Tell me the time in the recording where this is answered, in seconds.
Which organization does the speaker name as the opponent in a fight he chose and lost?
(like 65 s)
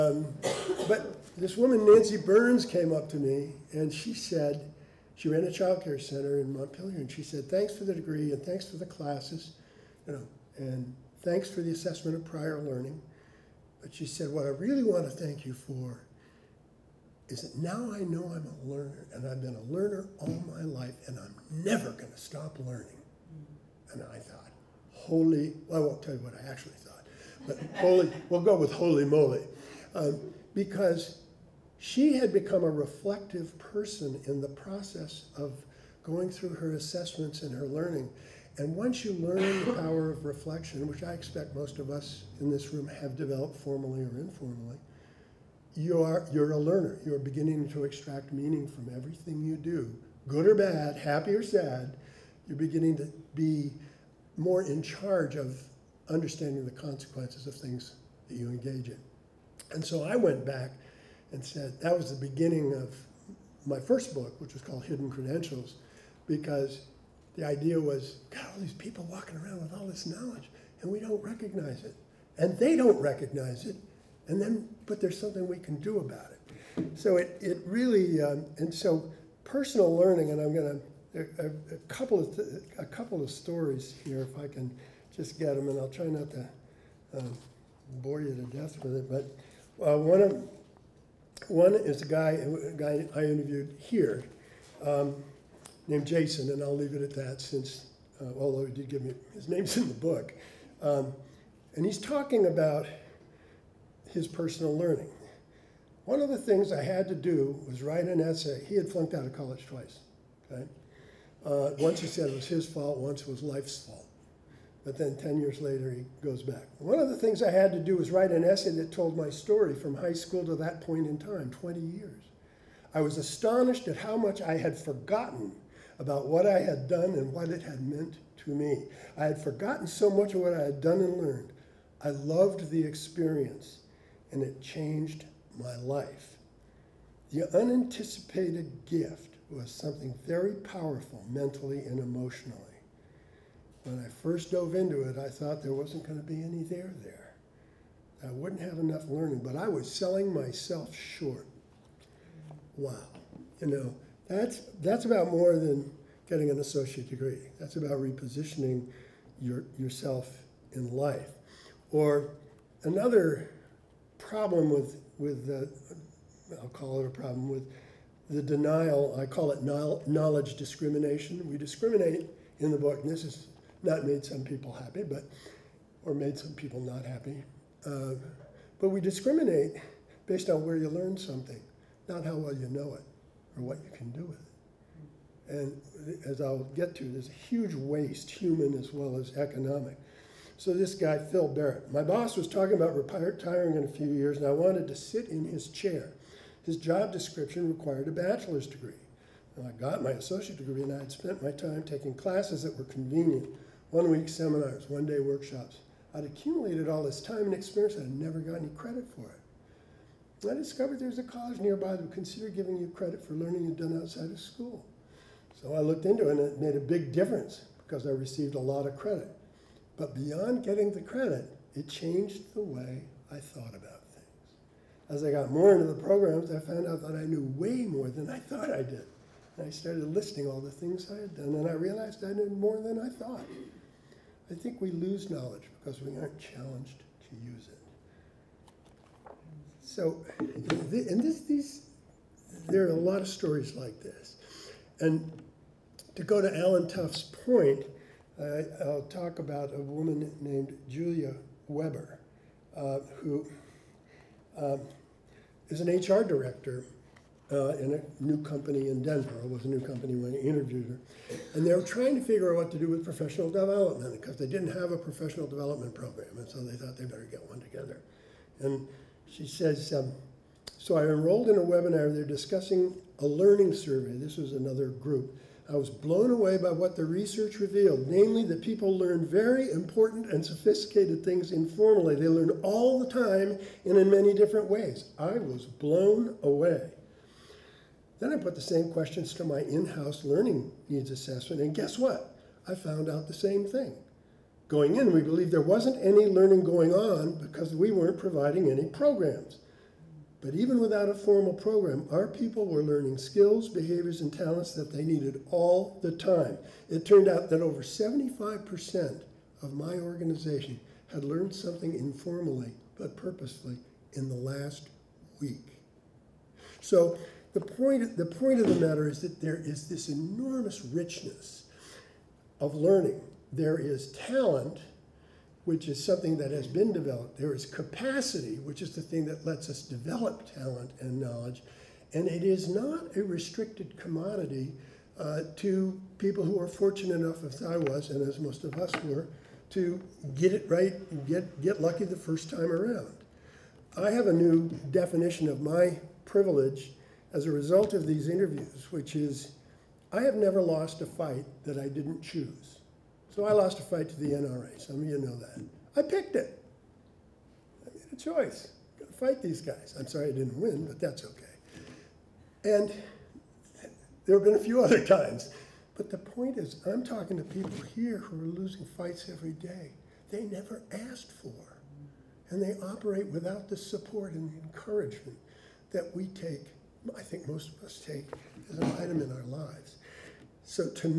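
354 s.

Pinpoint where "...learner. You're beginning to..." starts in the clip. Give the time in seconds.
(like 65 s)
46 s.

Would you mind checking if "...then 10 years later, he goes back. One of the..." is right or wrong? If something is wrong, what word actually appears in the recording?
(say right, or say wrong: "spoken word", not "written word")
right.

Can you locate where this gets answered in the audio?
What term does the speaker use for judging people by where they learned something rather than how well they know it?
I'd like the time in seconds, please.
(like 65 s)
169 s.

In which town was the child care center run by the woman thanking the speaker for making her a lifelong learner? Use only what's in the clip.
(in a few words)
Montpelier.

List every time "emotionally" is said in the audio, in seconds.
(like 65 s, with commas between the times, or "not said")
141 s.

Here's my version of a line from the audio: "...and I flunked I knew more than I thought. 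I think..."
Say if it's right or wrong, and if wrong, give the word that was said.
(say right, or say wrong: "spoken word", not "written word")
wrong: "realized", not "flunked".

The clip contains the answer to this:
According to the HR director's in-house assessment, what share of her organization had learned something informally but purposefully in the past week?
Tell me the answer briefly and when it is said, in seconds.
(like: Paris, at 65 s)
over 75%, at 307 s.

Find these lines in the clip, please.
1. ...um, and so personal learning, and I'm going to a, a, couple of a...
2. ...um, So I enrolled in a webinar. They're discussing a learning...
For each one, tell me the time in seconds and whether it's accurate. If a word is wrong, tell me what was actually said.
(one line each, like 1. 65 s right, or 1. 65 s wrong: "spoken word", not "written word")
1. 78 s right
2. 269 s right.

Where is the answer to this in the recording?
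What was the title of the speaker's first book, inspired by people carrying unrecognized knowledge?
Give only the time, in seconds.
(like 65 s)
64 s.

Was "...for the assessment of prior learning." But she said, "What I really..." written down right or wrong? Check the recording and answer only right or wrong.
right.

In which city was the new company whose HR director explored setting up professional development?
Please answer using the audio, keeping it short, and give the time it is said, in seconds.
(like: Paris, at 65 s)
Denver, at 259 s.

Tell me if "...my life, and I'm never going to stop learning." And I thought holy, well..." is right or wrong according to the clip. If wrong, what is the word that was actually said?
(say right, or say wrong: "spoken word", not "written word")
right.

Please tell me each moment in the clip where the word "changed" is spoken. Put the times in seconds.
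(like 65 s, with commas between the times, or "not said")
134 s, 221 s.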